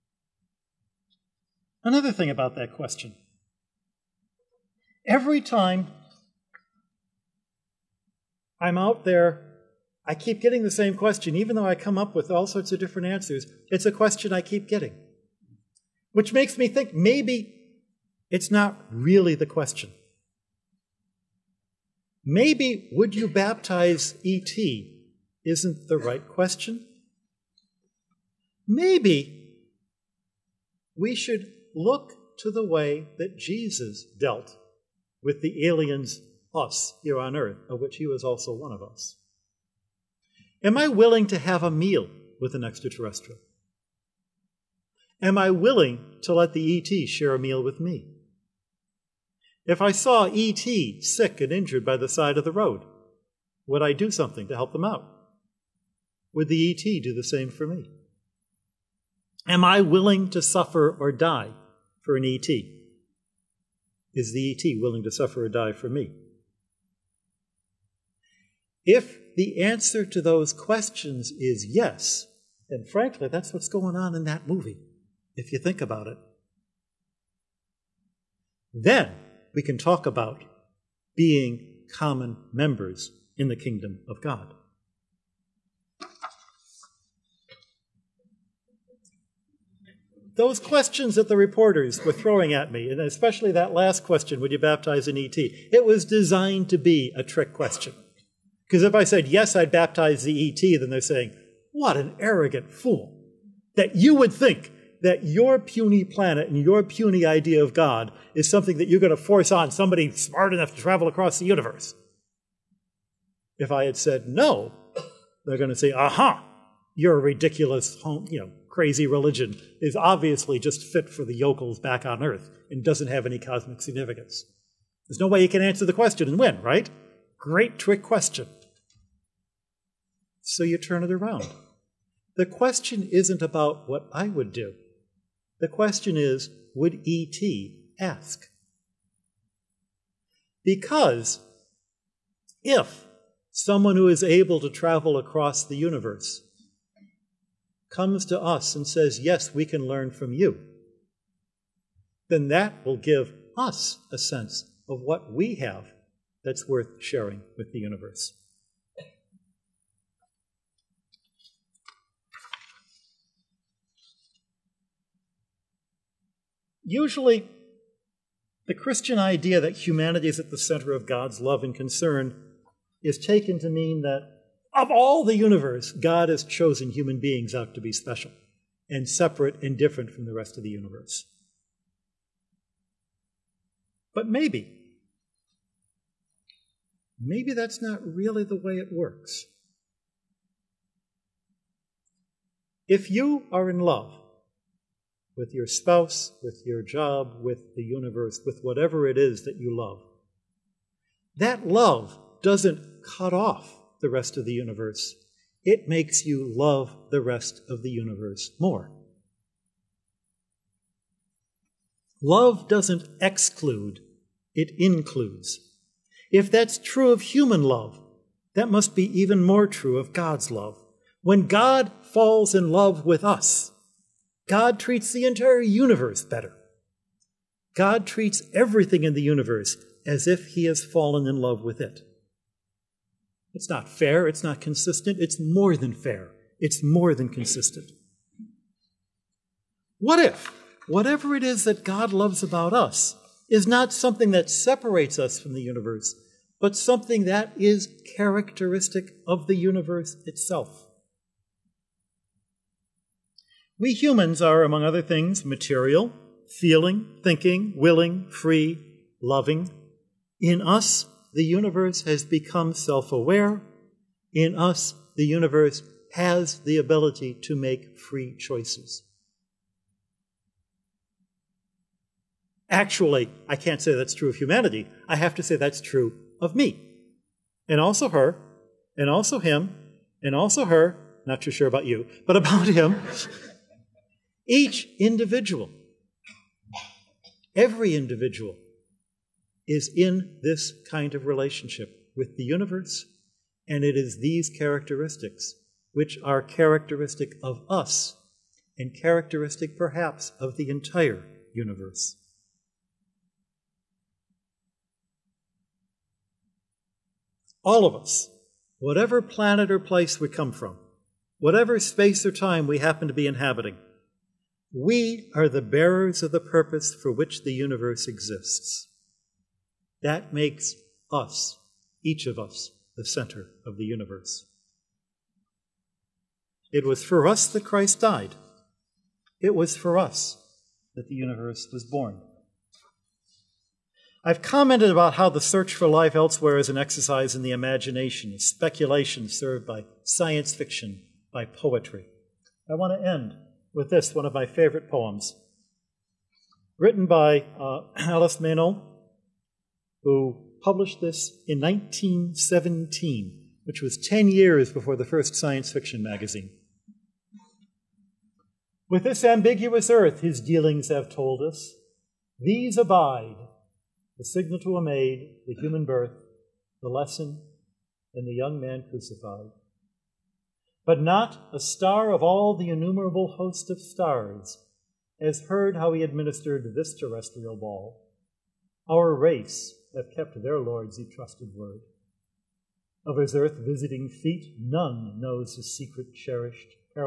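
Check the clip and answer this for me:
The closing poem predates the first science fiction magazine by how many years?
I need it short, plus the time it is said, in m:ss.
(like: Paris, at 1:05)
10 years, at 5:53.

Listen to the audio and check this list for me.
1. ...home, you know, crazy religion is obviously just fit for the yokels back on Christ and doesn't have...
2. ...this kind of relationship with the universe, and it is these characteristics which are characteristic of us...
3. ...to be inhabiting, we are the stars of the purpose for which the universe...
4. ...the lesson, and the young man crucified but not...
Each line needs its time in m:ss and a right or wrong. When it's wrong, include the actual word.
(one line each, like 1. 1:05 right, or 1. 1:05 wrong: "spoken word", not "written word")
1. 1:58 wrong: "Earth", not "Christ"
2. 4:50 right
3. 5:13 wrong: "bearers", not "stars"
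4. 6:06 right.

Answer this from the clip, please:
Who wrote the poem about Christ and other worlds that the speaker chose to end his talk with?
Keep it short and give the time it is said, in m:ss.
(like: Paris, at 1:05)
Alice Maynell, at 5:47.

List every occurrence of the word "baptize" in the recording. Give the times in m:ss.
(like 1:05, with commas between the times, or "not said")
0:23, 1:34, 1:39.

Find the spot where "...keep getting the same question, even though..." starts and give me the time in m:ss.
0:10.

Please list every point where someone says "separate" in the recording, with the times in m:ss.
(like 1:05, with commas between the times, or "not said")
2:59, 4:04.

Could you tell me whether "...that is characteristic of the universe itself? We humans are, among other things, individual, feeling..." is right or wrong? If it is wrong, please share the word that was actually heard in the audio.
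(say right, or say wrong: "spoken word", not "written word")
wrong: "material", not "individual".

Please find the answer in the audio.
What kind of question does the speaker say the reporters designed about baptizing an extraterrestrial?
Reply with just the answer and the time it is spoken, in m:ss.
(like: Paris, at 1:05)
A trick question, at 1:37.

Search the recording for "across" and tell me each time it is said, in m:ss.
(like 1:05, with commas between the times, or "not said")
1:51, 2:25.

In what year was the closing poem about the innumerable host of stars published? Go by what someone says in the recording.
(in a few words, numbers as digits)
1917.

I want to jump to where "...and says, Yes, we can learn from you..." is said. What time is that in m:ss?
2:28.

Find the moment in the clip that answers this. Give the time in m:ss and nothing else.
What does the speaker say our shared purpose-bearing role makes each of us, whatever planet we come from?
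5:22.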